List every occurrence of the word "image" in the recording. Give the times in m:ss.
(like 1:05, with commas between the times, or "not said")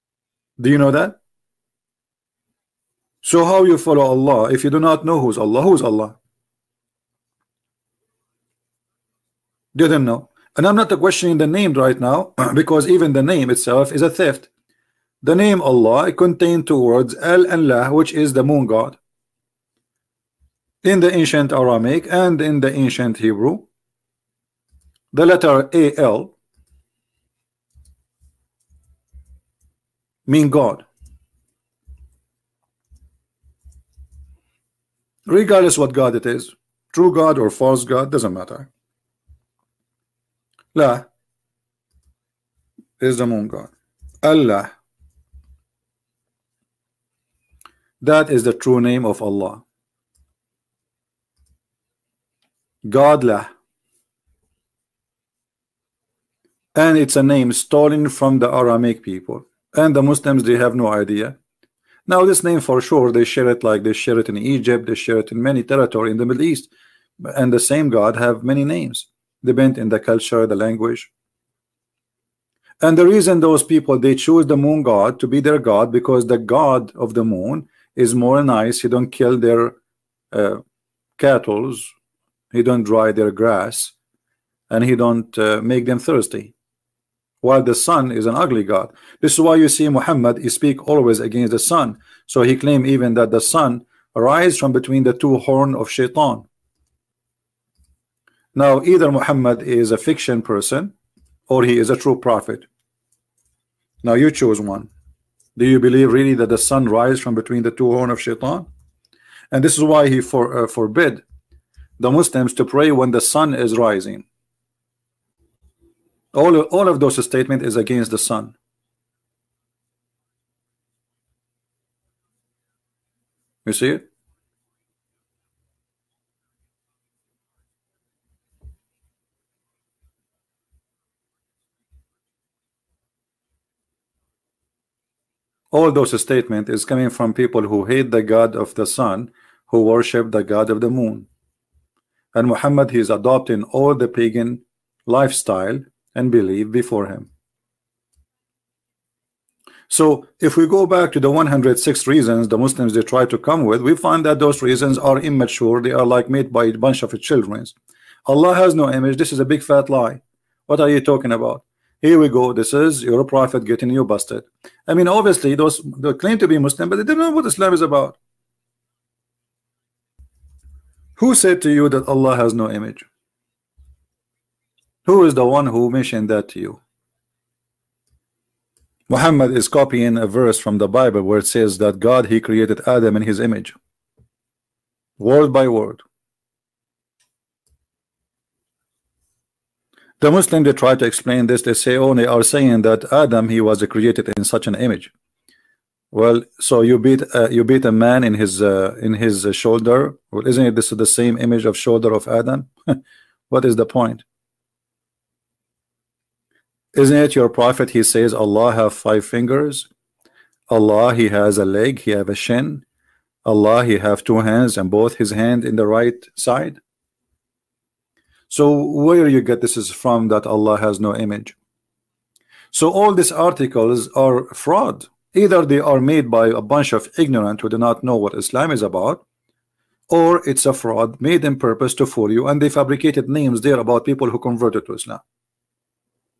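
2:38, 2:52, 3:03, 3:14, 3:21, 3:41.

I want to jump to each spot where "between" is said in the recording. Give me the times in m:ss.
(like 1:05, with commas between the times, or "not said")
1:34, 1:47.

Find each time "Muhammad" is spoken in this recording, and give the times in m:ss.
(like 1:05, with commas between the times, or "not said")
1:29, 1:39, 2:22, 2:59.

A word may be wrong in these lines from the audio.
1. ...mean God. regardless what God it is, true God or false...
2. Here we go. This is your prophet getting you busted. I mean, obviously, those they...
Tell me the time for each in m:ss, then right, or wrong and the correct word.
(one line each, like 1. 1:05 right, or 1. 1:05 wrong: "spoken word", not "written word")
1. 0:30 right
2. 2:42 right.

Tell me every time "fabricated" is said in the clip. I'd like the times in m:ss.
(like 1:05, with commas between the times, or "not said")
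3:52.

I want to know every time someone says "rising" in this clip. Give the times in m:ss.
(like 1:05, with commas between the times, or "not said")
1:53.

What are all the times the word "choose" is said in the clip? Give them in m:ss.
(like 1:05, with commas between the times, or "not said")
1:14, 1:44.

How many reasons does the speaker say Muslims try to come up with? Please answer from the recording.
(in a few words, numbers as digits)
106.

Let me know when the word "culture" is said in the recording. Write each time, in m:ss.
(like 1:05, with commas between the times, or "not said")
1:09.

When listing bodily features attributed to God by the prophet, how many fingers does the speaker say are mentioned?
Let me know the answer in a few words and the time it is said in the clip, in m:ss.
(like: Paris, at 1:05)
5, at 3:28.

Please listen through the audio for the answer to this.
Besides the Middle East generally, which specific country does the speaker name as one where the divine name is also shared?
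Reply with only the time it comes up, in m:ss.
1:04.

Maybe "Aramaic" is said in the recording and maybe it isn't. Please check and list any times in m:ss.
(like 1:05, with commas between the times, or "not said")
0:21, 0:58.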